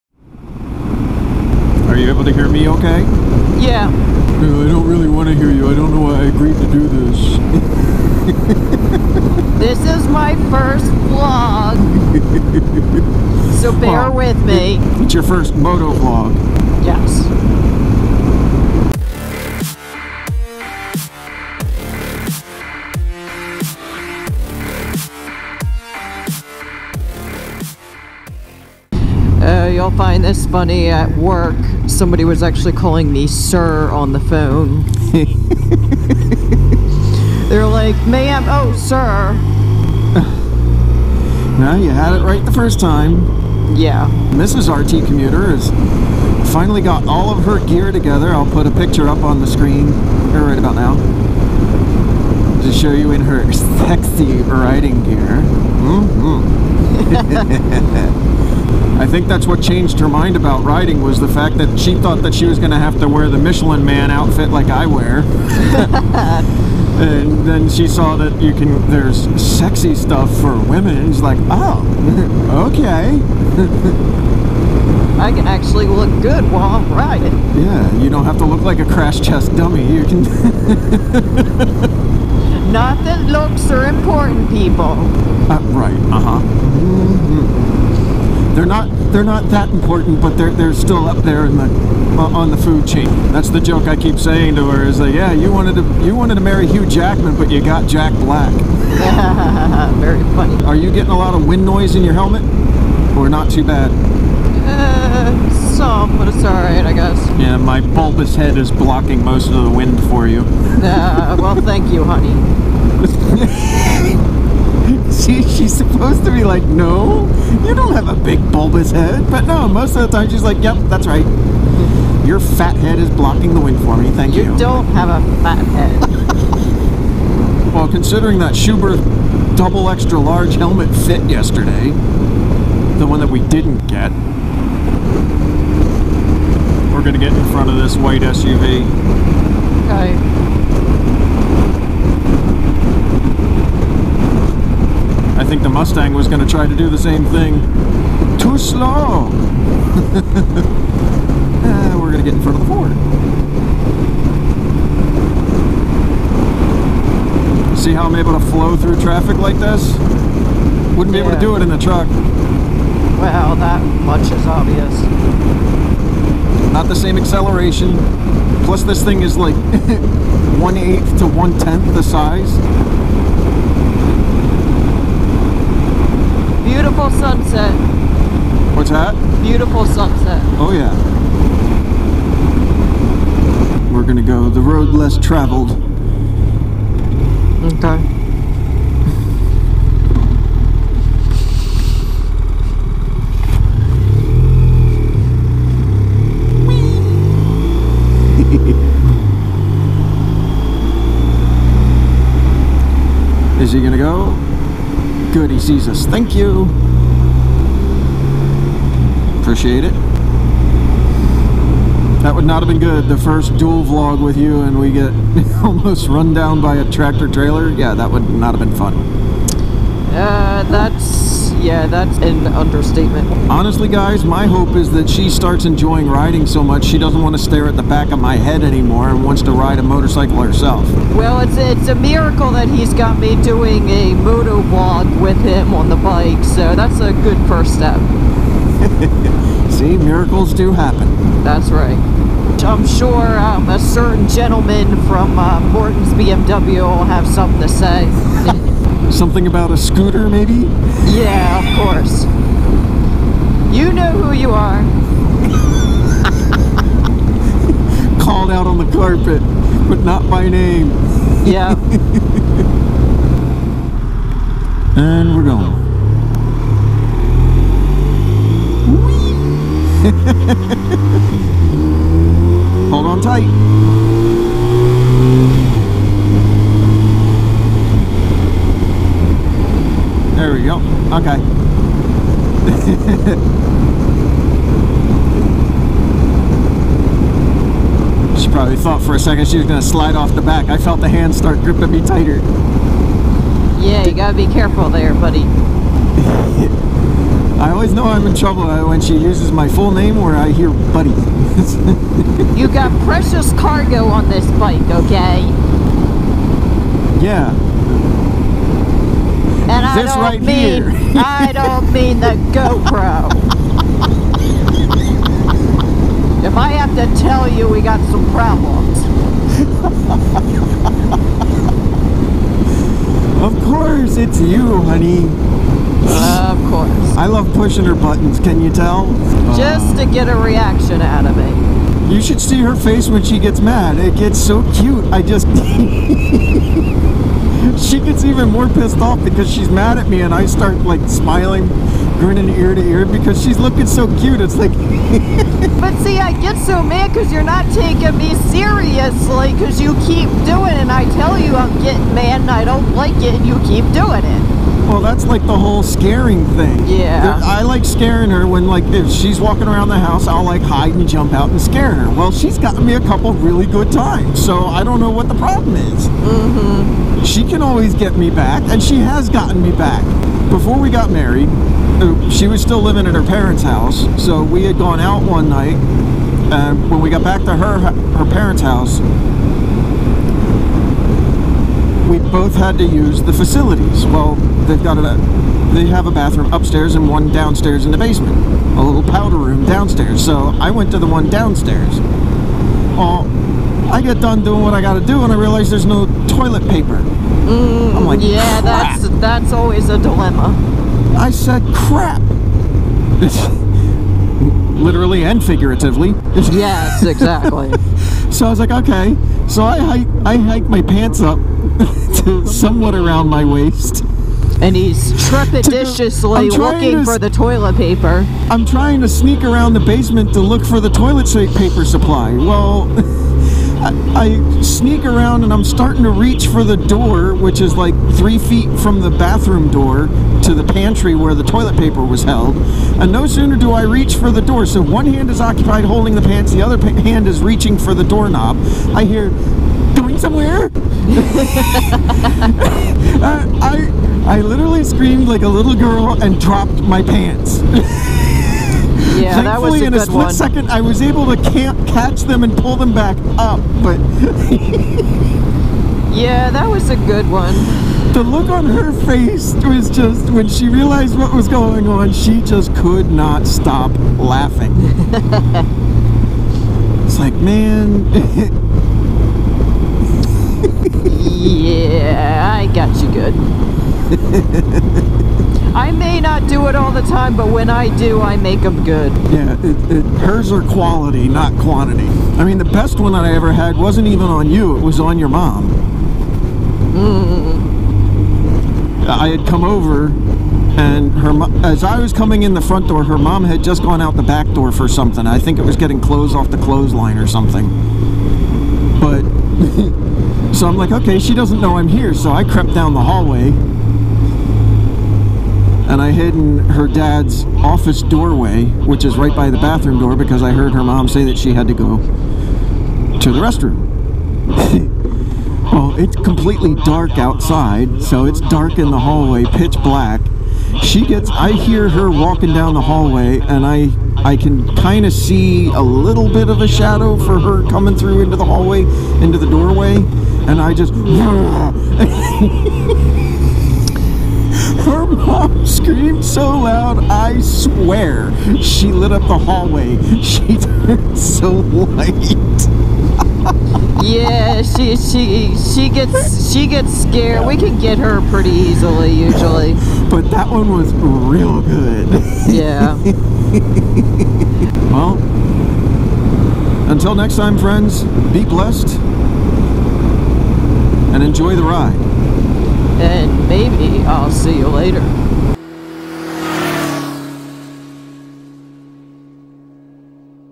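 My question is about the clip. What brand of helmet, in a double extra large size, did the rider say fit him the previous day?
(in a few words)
Schuberth.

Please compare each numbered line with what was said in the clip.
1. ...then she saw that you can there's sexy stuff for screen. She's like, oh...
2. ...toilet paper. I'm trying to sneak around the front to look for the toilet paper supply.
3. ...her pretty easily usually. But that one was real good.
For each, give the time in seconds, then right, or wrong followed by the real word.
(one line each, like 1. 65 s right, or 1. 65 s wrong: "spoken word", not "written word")
1. 67 s wrong: "women", not "screen"
2. 417 s wrong: "basement", not "front"
3. 547 s right.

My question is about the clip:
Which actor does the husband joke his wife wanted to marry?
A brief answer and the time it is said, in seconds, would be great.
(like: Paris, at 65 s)
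Hugh Jackman, at 96 s.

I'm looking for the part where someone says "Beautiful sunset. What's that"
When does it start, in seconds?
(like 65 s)
176 s.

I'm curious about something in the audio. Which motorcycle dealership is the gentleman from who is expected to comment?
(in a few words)
Morton's BMW.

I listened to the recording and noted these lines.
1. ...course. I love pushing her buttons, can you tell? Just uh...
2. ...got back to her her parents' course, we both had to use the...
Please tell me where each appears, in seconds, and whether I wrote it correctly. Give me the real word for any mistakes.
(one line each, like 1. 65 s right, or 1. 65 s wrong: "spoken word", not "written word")
1. 326 s right
2. 377 s wrong: "house", not "course".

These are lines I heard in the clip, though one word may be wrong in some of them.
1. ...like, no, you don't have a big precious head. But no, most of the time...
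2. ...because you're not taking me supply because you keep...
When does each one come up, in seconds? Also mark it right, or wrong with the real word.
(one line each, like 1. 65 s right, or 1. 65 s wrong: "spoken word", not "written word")
1. 116 s wrong: "bulbous", not "precious"
2. 347 s wrong: "seriously", not "supply".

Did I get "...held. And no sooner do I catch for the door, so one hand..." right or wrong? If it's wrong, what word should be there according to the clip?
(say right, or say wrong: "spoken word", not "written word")
wrong: "reach", not "catch".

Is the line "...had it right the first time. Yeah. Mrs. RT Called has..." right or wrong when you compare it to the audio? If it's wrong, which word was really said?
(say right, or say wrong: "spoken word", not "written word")
wrong: "Commuter", not "Called".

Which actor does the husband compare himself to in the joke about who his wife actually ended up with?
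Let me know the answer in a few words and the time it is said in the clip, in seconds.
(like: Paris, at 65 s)
Jack Black, at 97 s.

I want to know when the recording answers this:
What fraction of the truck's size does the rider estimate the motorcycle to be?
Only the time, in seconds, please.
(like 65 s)
170 s.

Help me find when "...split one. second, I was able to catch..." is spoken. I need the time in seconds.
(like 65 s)
450 s.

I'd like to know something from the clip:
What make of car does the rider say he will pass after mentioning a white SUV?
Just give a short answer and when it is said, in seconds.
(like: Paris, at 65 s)
Ford, at 152 s.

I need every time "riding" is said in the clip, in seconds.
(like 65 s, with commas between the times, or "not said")
54 s, 60 s, 76 s, 226 s.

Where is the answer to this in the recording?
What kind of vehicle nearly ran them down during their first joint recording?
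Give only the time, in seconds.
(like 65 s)
216 s.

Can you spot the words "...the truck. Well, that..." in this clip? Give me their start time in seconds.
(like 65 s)
161 s.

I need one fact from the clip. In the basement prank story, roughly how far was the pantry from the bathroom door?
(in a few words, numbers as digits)
3 feet.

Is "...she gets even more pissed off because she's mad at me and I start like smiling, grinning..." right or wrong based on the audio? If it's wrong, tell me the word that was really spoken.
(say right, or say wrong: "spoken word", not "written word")
right.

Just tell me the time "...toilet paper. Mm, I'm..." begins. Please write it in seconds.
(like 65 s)
396 s.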